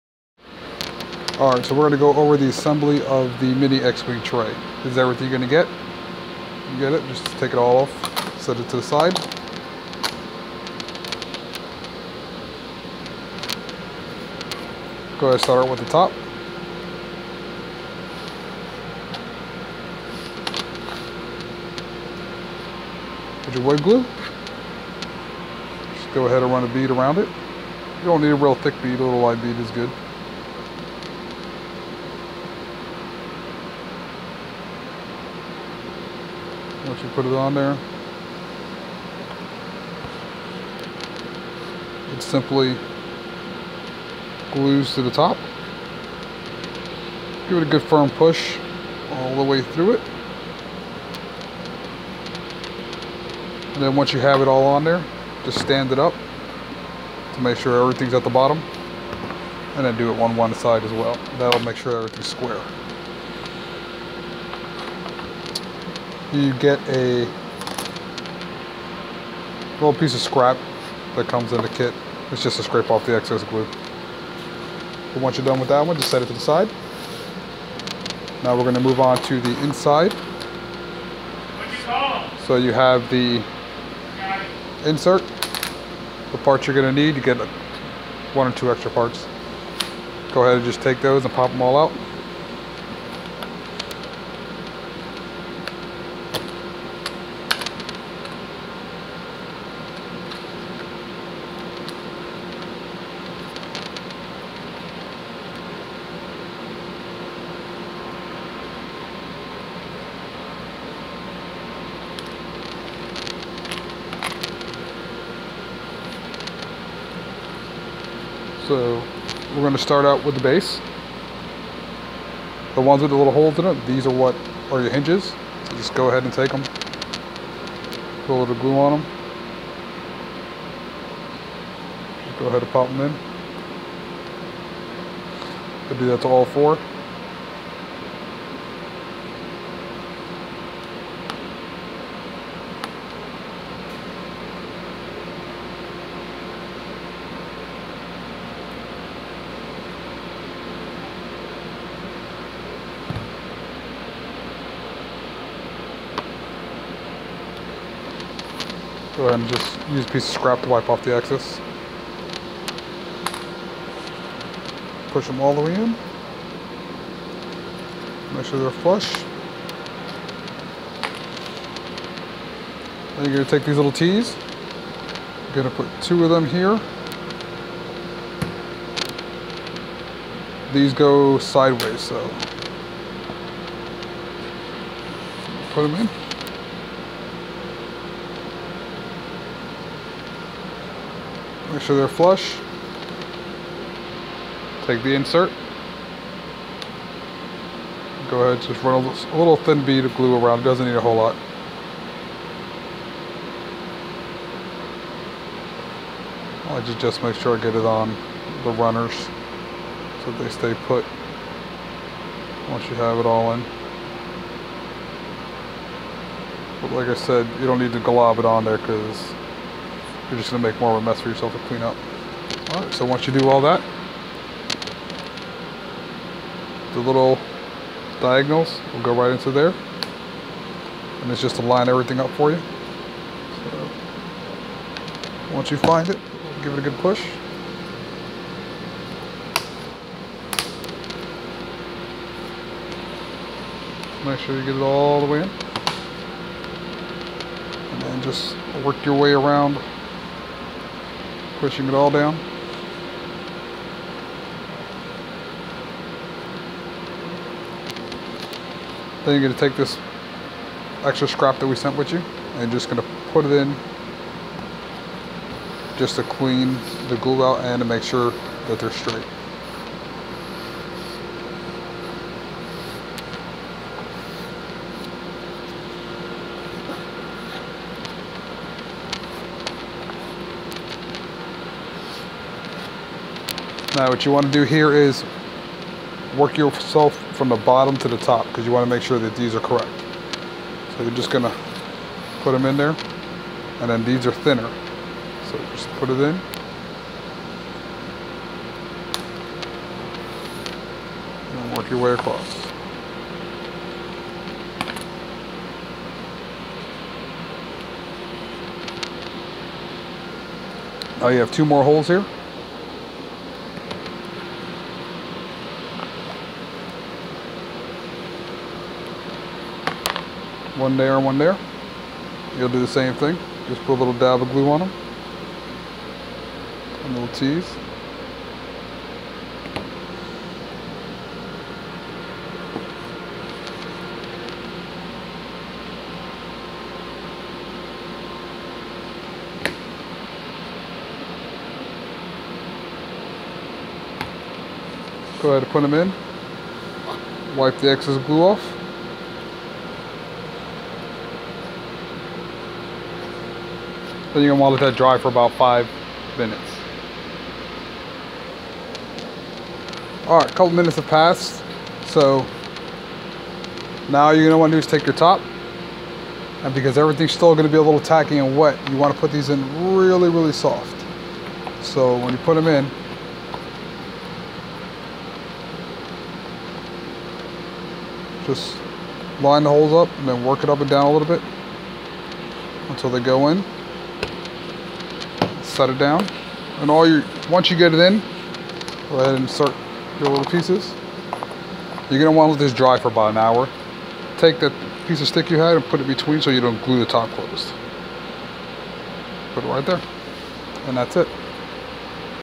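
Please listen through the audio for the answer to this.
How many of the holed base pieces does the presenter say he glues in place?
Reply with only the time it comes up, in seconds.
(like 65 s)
136 s.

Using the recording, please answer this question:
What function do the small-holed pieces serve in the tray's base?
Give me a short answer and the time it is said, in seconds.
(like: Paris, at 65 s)
Hinges, at 124 s.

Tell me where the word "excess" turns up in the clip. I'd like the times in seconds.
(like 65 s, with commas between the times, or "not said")
73 s, 161 s, 347 s.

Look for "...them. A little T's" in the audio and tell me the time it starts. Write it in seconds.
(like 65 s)
324 s.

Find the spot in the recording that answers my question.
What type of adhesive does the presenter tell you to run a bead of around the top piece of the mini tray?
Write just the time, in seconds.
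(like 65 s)
23 s.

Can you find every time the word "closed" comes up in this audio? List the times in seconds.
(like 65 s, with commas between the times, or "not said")
397 s.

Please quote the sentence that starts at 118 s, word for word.
So we're going to start out with the base.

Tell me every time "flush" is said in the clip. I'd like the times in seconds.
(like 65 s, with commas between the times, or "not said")
168 s, 192 s.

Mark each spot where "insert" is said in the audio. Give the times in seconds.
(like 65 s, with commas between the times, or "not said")
84 s, 195 s, 389 s.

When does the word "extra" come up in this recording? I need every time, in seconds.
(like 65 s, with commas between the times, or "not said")
88 s, 261 s.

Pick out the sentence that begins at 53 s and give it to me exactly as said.
And then once you have it all on there, just stand it up to make sure everything's at the bottom.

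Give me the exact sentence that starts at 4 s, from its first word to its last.
This is everything you're gonna get.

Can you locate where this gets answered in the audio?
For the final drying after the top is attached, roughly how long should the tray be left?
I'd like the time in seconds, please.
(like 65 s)
393 s.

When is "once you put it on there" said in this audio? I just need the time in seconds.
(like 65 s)
36 s.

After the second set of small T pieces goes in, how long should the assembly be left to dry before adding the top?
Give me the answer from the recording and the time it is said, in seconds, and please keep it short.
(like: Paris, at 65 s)
5 minutes, at 355 s.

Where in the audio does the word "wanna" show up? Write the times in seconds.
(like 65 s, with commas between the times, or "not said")
354 s, 364 s, 368 s, 392 s.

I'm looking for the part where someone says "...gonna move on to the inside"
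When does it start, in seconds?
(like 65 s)
78 s.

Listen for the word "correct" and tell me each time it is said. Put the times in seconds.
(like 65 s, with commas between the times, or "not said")
289 s.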